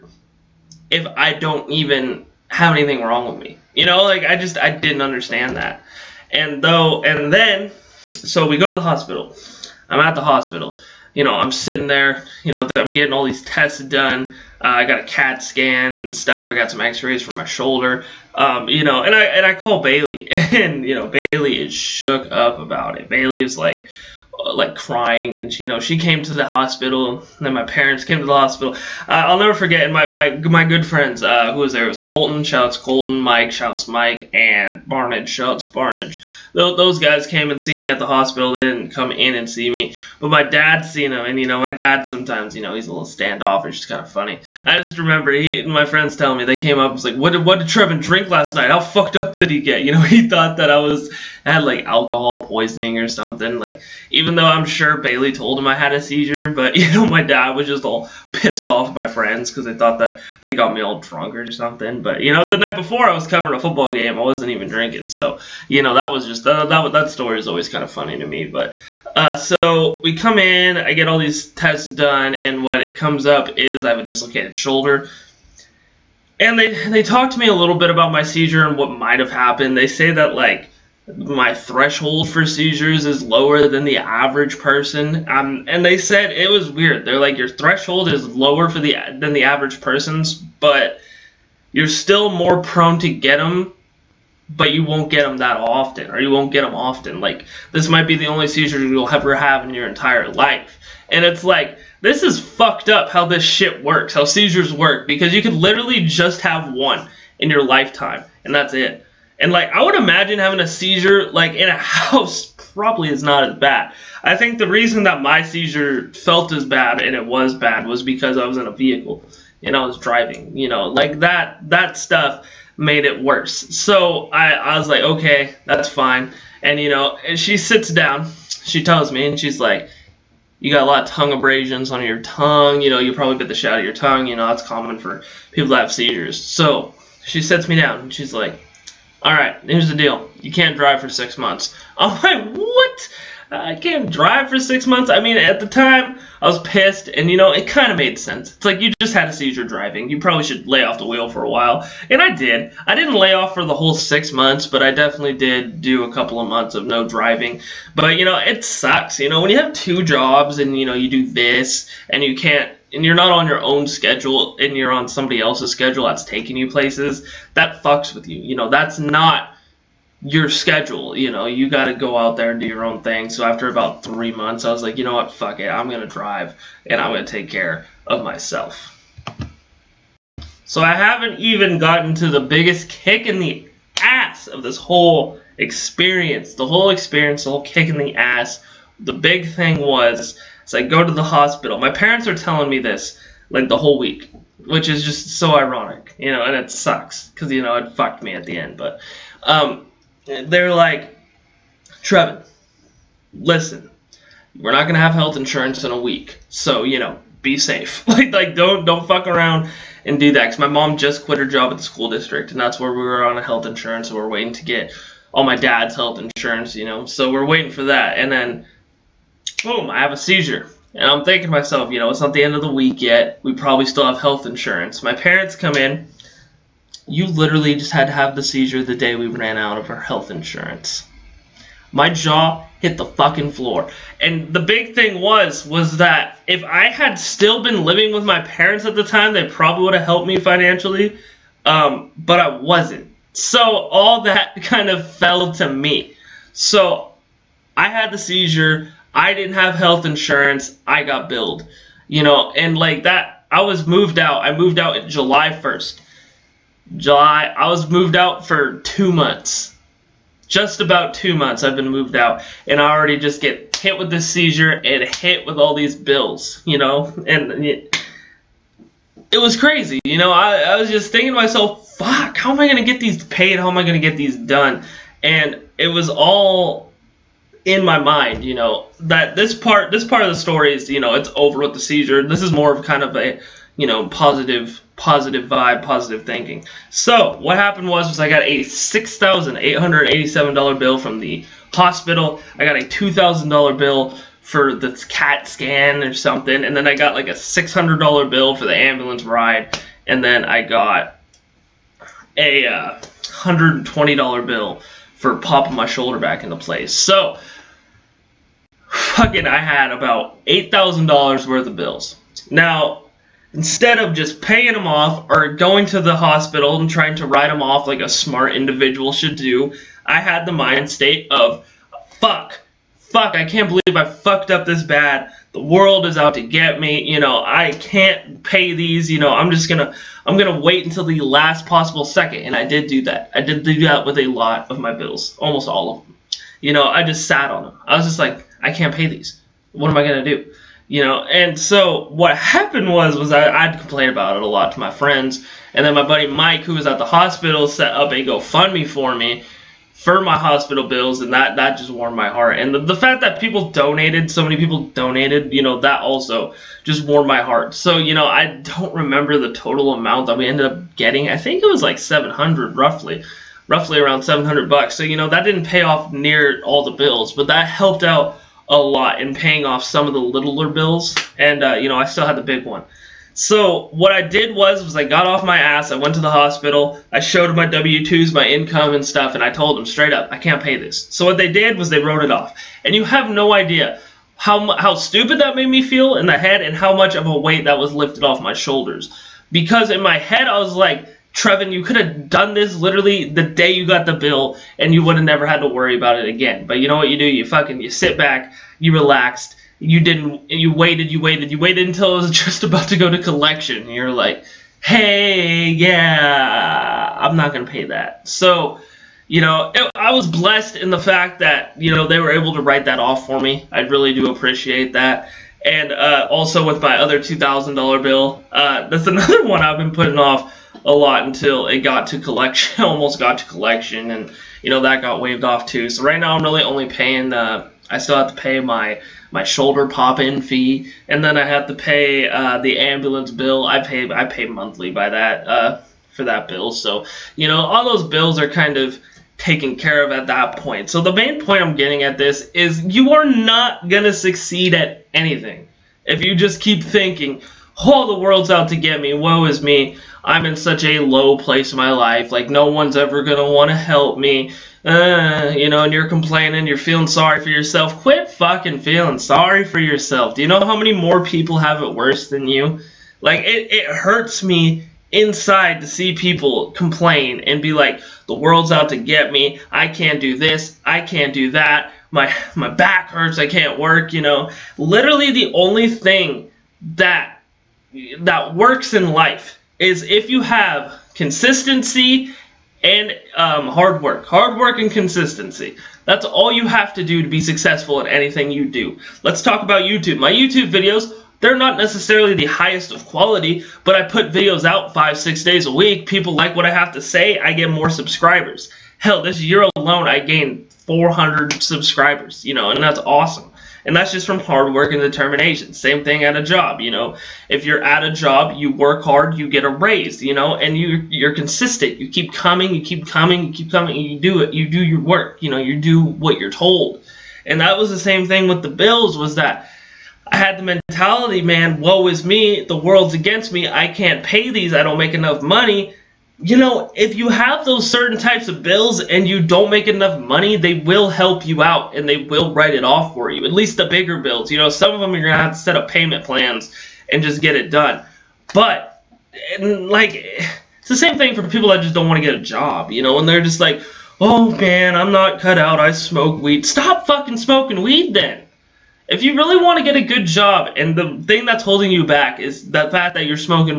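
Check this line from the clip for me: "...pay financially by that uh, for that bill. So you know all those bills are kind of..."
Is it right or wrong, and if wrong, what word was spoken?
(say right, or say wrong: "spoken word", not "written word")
wrong: "monthly", not "financially".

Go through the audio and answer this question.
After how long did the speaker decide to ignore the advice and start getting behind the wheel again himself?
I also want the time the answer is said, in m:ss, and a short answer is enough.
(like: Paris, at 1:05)
3 months, at 2:54.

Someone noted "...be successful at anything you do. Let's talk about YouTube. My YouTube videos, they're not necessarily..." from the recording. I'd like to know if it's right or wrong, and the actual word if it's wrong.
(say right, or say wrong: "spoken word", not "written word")
right.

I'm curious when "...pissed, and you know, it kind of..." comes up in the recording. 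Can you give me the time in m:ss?
2:26.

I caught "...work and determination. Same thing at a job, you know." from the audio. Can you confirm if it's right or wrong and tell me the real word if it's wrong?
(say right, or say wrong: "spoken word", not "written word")
right.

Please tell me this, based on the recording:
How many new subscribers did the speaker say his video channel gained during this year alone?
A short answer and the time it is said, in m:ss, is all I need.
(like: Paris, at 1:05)
400, at 8:20.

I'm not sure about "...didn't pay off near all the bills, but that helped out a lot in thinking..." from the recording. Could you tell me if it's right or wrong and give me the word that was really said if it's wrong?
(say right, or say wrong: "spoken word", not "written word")
wrong: "paying", not "thinking".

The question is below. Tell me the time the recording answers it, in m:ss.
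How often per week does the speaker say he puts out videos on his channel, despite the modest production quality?
8:14.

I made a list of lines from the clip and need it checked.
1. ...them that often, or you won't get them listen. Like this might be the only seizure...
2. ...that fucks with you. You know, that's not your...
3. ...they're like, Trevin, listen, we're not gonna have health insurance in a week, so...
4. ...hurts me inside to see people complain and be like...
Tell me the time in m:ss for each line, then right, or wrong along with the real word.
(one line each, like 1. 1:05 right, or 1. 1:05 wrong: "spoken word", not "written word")
1. 1:35 wrong: "often", not "listen"
2. 2:47 right
3. 3:20 right
4. 7:43 right.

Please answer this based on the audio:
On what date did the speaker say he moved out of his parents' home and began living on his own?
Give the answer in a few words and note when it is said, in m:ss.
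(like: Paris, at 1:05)
July 1st, at 4:15.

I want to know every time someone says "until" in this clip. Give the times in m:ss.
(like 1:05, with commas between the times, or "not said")
5:30, 6:41, 7:01.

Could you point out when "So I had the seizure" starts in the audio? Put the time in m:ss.
4:06.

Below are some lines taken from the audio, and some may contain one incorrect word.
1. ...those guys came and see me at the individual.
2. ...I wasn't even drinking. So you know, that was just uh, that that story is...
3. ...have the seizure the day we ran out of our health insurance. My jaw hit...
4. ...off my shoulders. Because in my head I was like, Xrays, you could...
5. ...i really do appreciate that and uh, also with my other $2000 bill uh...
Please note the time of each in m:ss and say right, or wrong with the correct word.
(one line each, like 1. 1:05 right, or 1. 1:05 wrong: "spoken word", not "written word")
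1. 0:36 wrong: "hospital", not "individual"
2. 1:04 right
3. 3:48 right
4. 6:28 wrong: "Trevin", not "Xrays"
5. 6:53 right.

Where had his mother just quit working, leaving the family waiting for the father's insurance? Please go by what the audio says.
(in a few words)
school district.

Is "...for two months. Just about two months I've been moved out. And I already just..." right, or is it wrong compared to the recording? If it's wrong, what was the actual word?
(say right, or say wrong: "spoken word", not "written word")
right.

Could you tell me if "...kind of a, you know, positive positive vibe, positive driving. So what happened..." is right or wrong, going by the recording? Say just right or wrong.
wrong.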